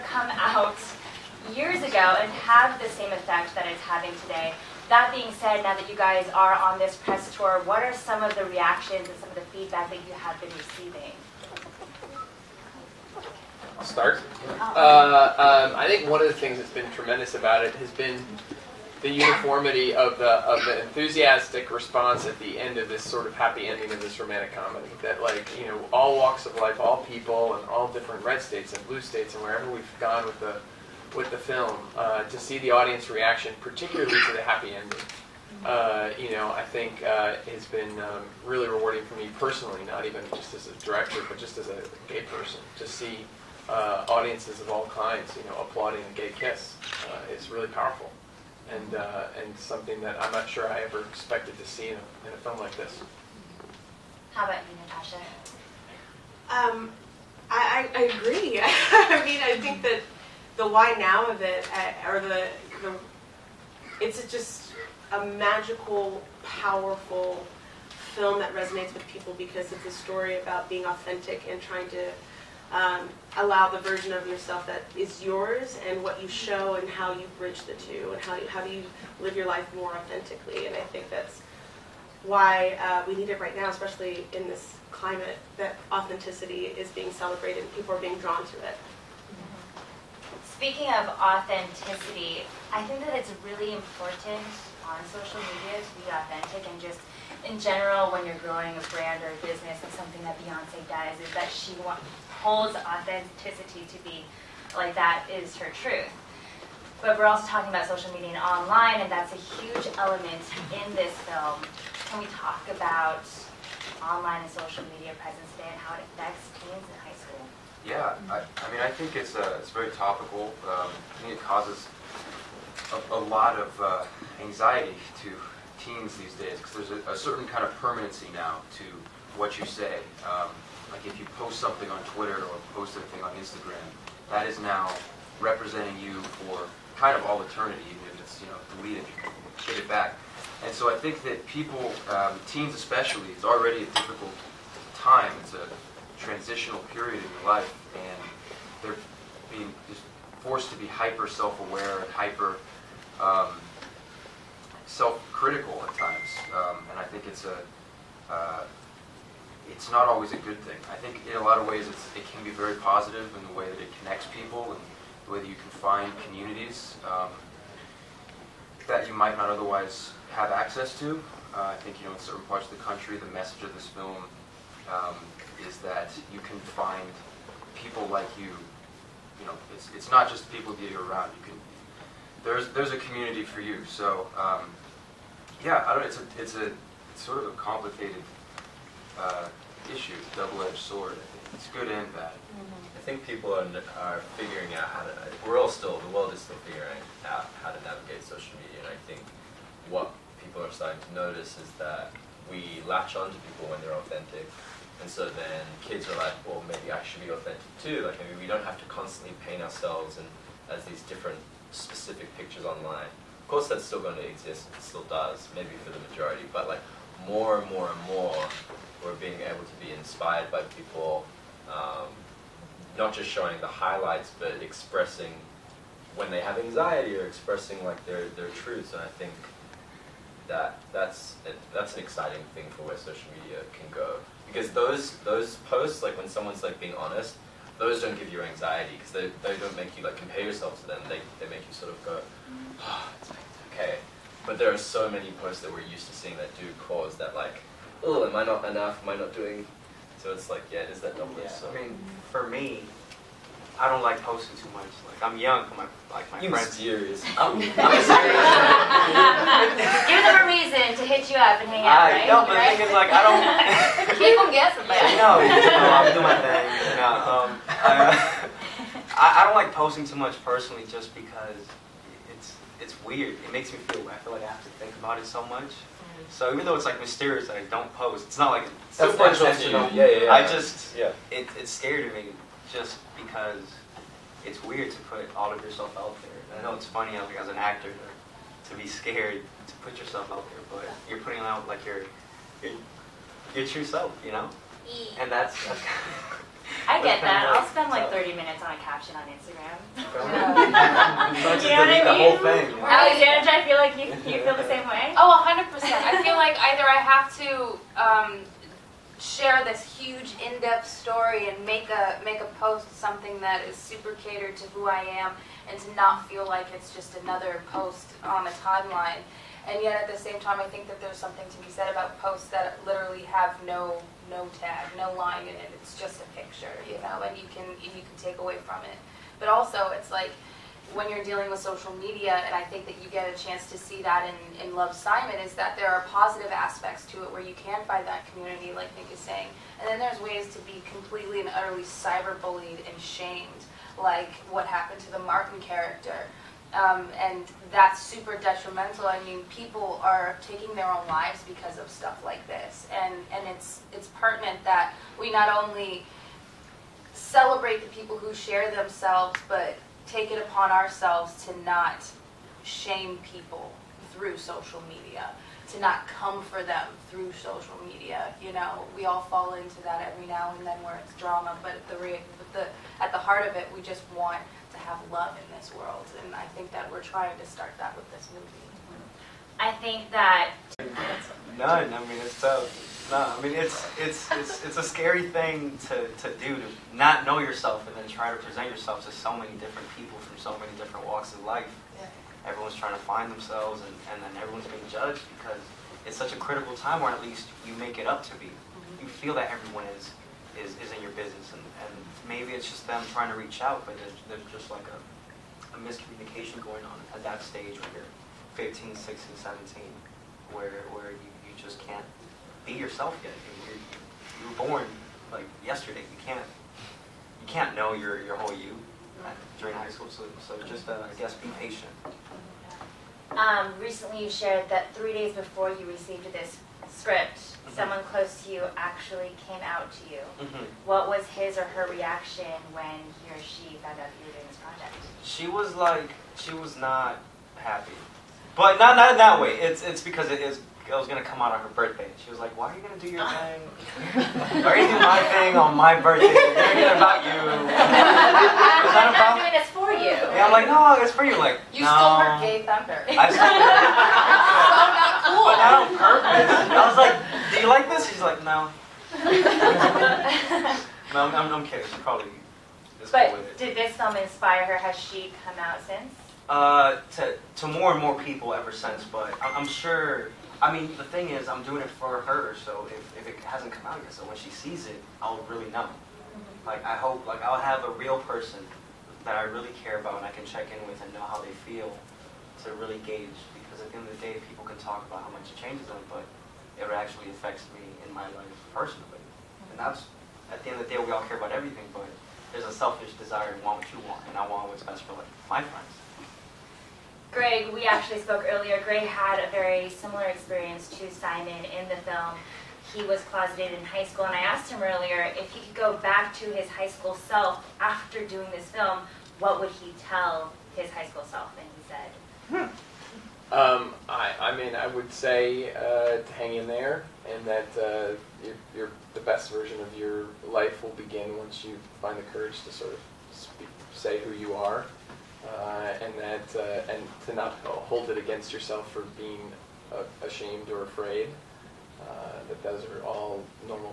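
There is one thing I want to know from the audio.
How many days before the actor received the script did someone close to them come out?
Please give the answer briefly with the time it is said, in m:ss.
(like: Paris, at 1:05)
3 days, at 7:04.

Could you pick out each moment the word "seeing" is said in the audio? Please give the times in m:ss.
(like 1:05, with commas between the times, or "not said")
4:06.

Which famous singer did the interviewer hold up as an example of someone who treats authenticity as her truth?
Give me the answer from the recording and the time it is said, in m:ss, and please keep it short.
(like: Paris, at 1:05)
Beyonce, at 1:40.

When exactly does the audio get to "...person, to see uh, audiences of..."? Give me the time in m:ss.
0:42.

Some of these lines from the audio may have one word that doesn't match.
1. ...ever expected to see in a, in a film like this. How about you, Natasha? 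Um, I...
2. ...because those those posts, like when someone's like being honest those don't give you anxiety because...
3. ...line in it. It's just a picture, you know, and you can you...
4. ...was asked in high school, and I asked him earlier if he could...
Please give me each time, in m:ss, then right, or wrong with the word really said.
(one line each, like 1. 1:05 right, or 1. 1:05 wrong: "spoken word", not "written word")
1. 0:50 right
2. 3:54 right
3. 5:25 right
4. 8:23 wrong: "closeted", not "asked".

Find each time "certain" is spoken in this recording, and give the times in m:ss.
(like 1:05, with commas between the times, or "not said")
2:07, 2:52.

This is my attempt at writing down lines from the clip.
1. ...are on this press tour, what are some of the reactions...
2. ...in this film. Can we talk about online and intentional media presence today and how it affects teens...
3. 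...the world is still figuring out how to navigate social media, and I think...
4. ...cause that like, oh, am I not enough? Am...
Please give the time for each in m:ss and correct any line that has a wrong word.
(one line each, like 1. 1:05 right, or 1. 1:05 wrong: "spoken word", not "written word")
1. 0:06 right
2. 1:50 wrong: "social", not "intentional"
3. 3:16 right
4. 4:06 right.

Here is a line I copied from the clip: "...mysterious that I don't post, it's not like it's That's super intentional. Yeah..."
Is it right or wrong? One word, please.
right.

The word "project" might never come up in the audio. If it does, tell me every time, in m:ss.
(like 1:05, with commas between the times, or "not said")
7:14.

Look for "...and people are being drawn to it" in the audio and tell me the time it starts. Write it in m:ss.
1:27.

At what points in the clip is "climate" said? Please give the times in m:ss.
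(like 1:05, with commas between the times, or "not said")
1:24.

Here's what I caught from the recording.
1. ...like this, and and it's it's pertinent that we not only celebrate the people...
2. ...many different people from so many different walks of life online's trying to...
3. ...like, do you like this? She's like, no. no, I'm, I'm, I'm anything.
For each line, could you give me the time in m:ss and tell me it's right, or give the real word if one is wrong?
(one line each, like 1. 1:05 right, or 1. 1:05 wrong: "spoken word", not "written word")
1. 5:52 right
2. 6:29 wrong: "everyone", not "online"
3. 7:36 wrong: "kidding", not "anything".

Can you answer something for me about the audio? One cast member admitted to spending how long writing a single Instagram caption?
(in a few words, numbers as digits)
30 minutes.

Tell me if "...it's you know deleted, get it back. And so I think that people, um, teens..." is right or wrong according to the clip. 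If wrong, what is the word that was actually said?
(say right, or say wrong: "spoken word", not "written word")
right.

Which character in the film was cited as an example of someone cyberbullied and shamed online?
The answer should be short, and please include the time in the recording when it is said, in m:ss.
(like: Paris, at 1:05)
Martin, at 5:45.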